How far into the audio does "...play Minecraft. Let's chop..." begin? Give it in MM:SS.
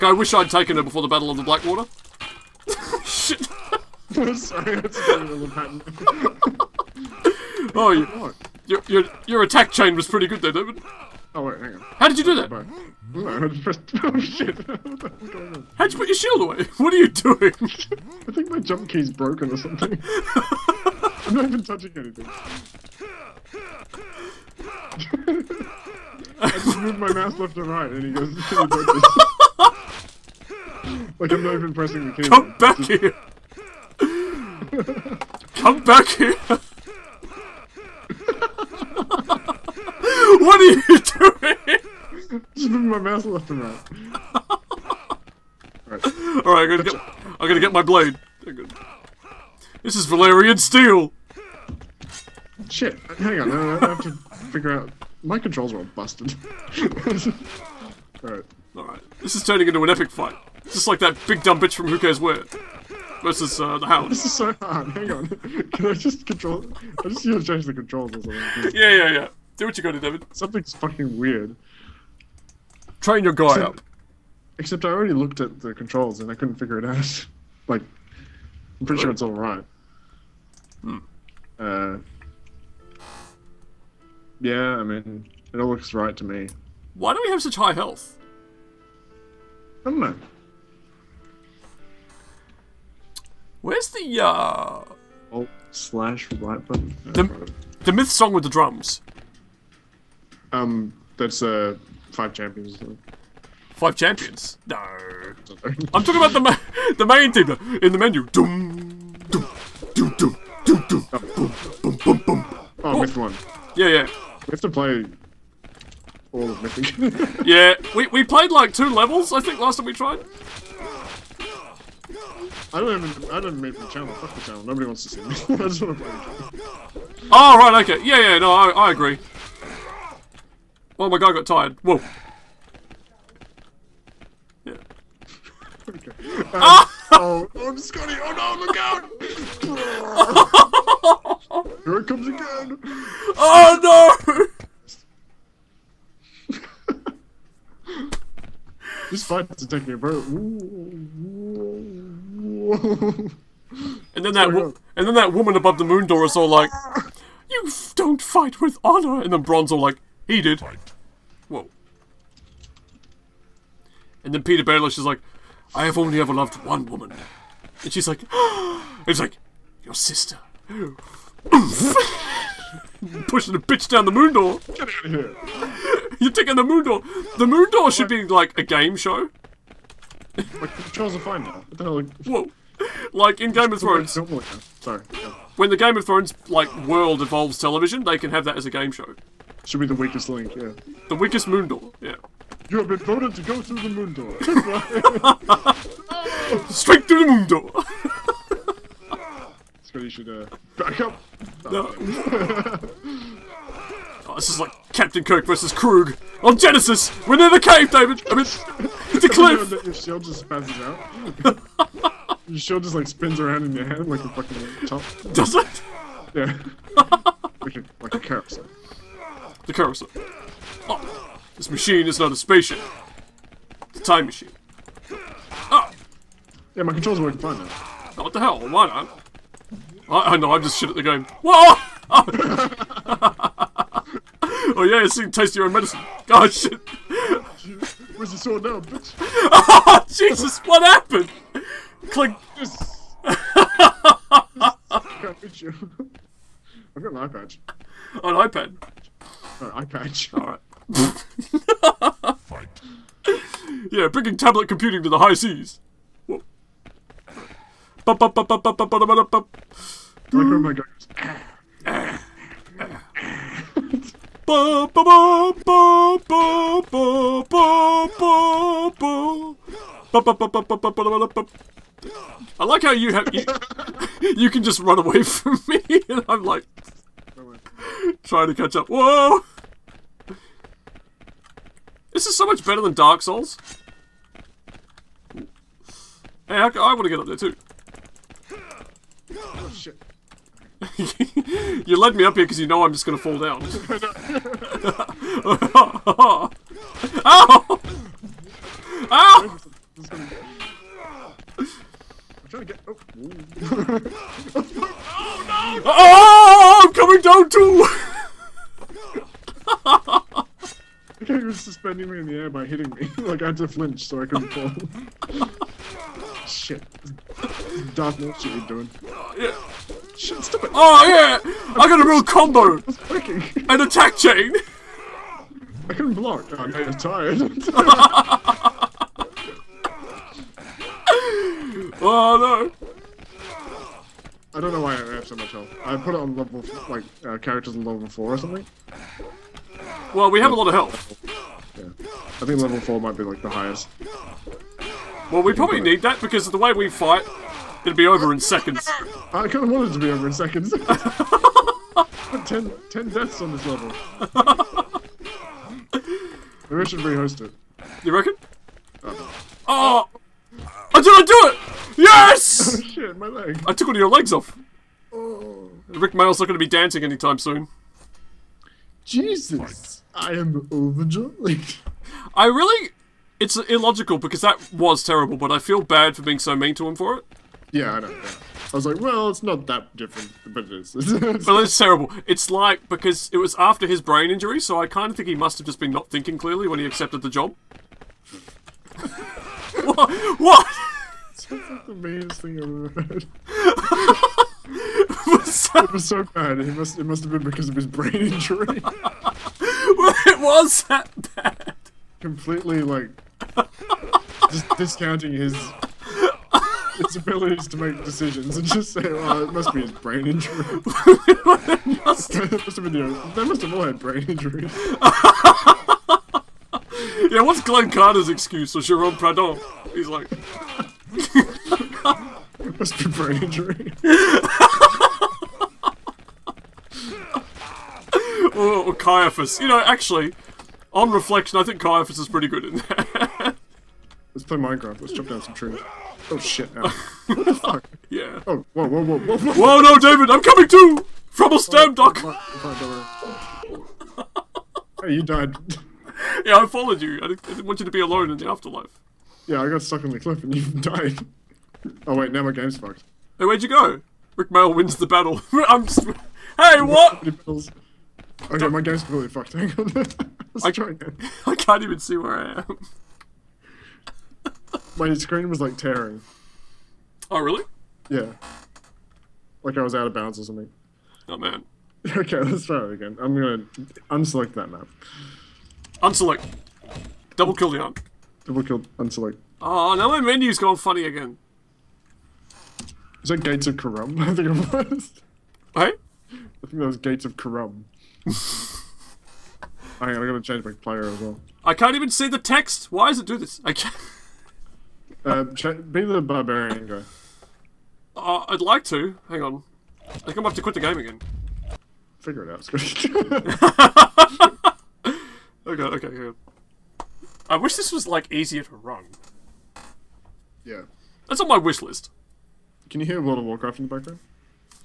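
07:14.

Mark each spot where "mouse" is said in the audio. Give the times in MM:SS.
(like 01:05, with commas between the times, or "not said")
00:27, 00:42.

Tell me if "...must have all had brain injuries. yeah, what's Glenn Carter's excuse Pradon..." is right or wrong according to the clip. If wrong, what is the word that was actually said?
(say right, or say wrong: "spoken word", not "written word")
wrong: "Was", not "Pradon".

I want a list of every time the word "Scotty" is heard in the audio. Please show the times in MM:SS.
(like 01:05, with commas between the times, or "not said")
02:17, 08:22.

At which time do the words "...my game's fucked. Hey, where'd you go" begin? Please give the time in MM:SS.
07:32.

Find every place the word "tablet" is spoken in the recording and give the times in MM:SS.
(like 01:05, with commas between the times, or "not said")
04:14.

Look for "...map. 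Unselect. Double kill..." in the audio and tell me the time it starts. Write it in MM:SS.
07:54.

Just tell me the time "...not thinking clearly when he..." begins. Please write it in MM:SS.
06:25.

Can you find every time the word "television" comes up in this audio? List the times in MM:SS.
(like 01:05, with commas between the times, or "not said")
03:07.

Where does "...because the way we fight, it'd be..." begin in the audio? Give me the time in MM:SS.
05:46.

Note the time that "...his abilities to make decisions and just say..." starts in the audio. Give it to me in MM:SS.
06:46.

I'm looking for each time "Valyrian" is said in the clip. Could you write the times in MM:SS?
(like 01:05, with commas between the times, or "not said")
00:50.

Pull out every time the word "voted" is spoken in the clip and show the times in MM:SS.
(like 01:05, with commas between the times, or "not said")
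03:12.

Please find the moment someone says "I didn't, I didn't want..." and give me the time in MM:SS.
07:27.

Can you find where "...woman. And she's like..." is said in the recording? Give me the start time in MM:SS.
02:46.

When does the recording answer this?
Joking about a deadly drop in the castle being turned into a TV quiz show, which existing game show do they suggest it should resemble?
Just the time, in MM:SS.
03:09.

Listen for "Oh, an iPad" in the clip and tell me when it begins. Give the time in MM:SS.
04:08.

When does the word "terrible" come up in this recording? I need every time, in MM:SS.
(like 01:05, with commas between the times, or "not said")
06:15, 06:21.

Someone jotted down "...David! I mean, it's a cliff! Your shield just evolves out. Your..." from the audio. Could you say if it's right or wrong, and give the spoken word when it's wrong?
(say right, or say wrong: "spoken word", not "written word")
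wrong: "passes", not "evolves".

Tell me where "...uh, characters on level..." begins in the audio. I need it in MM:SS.
05:37.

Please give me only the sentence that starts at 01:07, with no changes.
I just need to change the controls or something.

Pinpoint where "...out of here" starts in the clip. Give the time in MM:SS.
02:54.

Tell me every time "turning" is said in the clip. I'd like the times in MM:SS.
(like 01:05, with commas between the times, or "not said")
00:59.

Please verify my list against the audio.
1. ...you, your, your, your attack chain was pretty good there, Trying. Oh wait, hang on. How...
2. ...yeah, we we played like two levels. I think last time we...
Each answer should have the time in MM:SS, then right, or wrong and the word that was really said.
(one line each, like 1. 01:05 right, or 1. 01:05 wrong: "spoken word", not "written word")
1. 00:07 wrong: "David", not "Trying"
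2. 01:57 right.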